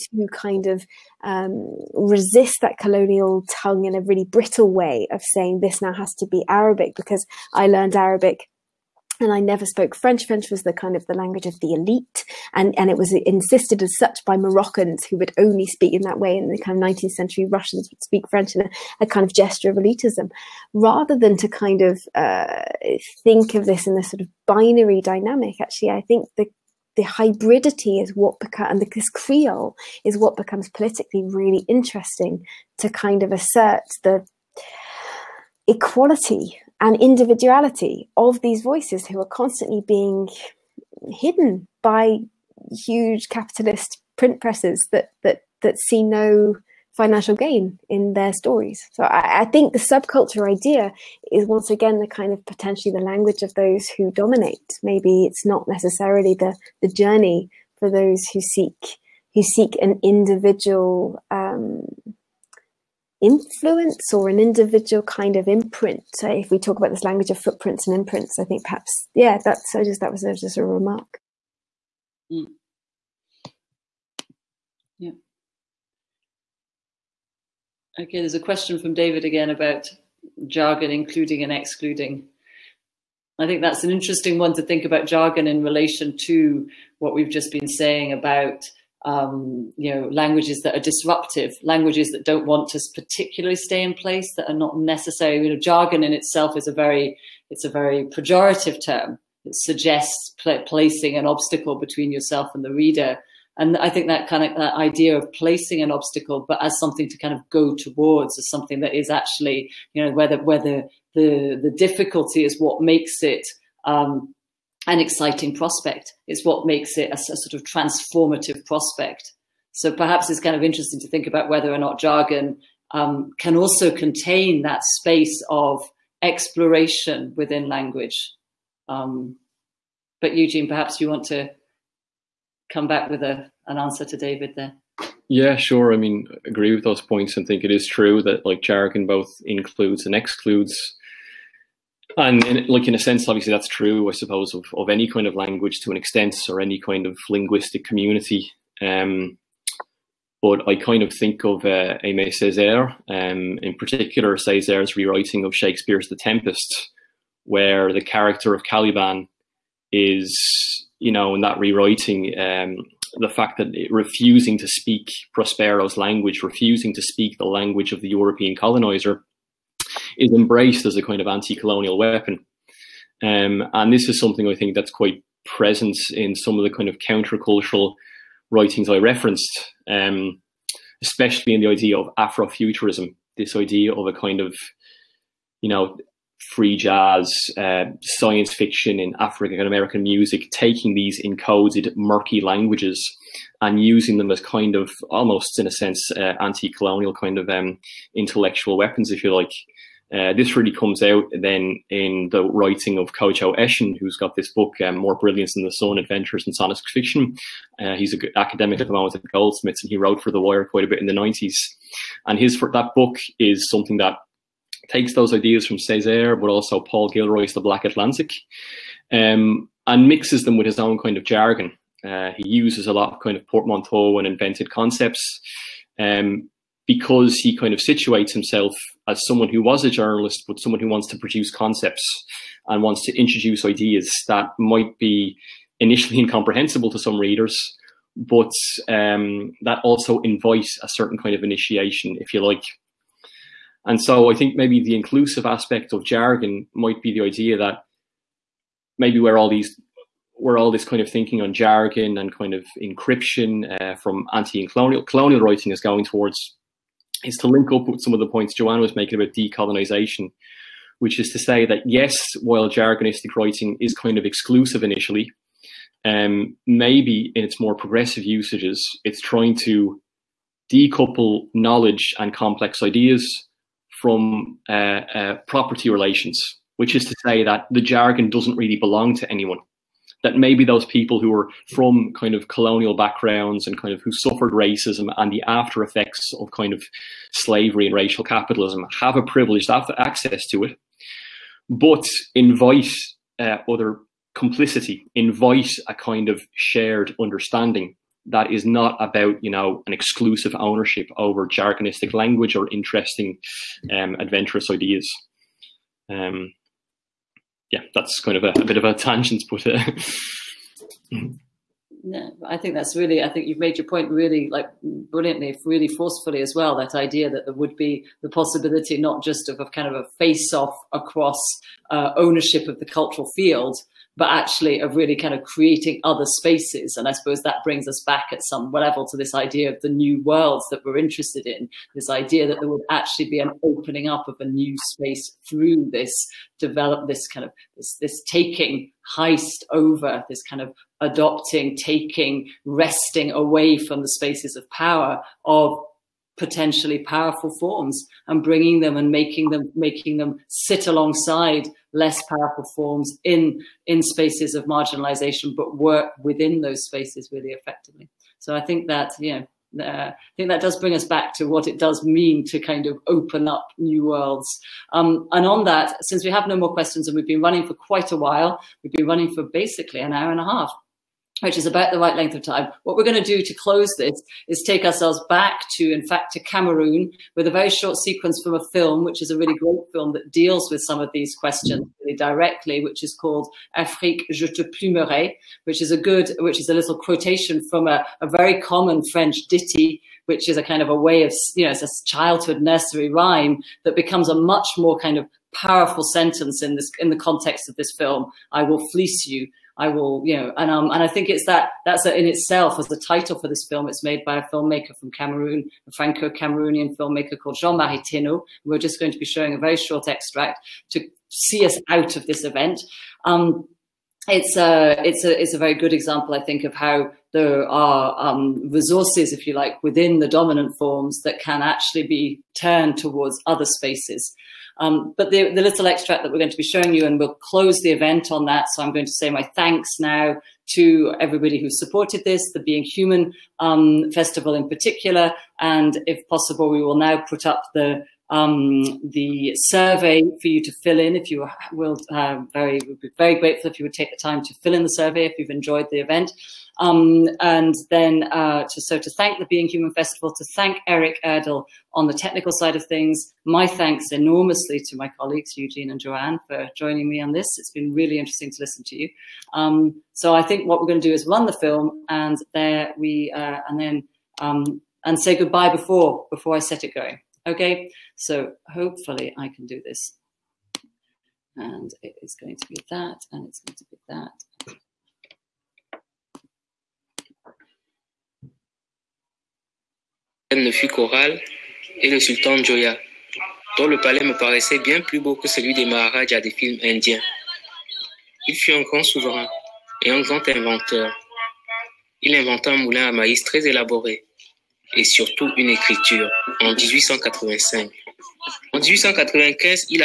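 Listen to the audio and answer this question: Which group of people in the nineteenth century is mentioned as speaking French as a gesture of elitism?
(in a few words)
Russians.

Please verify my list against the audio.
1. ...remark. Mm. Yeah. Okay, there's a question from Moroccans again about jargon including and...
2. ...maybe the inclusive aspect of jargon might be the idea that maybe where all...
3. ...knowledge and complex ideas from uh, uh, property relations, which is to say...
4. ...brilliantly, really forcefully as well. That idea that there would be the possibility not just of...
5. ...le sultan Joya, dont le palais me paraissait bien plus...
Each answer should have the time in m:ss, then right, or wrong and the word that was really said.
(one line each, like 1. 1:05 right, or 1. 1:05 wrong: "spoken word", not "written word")
1. 1:10 wrong: "David", not "Moroccans"
2. 4:04 right
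3. 4:31 right
4. 5:14 right
5. 8:02 right.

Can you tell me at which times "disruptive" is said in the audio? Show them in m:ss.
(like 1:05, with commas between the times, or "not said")
1:30.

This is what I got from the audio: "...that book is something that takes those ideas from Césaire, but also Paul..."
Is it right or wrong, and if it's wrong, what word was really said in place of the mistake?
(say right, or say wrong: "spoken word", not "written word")
right.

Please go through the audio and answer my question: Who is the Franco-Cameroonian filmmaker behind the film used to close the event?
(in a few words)
Jean-Marie Teno.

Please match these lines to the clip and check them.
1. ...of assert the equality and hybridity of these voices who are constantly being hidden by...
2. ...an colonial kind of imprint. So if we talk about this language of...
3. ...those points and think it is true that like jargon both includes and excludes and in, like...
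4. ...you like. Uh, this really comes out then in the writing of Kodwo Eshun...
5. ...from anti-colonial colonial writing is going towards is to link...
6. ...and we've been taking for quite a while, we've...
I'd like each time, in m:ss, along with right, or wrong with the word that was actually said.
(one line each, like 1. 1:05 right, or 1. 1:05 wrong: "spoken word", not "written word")
1. 0:33 wrong: "individuality", not "hybridity"
2. 1:04 wrong: "individual", not "colonial"
3. 2:16 right
4. 3:19 right
5. 4:13 right
6. 6:07 wrong: "running", not "taking".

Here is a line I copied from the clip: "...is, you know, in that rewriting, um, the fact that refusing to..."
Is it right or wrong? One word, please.
right.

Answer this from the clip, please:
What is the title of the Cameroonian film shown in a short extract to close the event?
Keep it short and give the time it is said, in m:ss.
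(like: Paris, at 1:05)
Afrique, je te plumerai, at 6:23.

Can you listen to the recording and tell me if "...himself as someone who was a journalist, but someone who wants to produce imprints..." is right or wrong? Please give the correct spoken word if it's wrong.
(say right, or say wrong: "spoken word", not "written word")
wrong: "concepts", not "imprints".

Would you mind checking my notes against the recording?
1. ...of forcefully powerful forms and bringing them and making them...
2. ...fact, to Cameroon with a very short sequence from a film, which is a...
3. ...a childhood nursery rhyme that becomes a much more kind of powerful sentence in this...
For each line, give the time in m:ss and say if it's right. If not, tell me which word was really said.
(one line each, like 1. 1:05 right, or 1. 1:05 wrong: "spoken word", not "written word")
1. 5:45 wrong: "potentially", not "forcefully"
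2. 6:16 right
3. 6:31 right.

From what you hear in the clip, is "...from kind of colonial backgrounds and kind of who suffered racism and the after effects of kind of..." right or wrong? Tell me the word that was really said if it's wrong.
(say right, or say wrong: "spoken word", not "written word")
right.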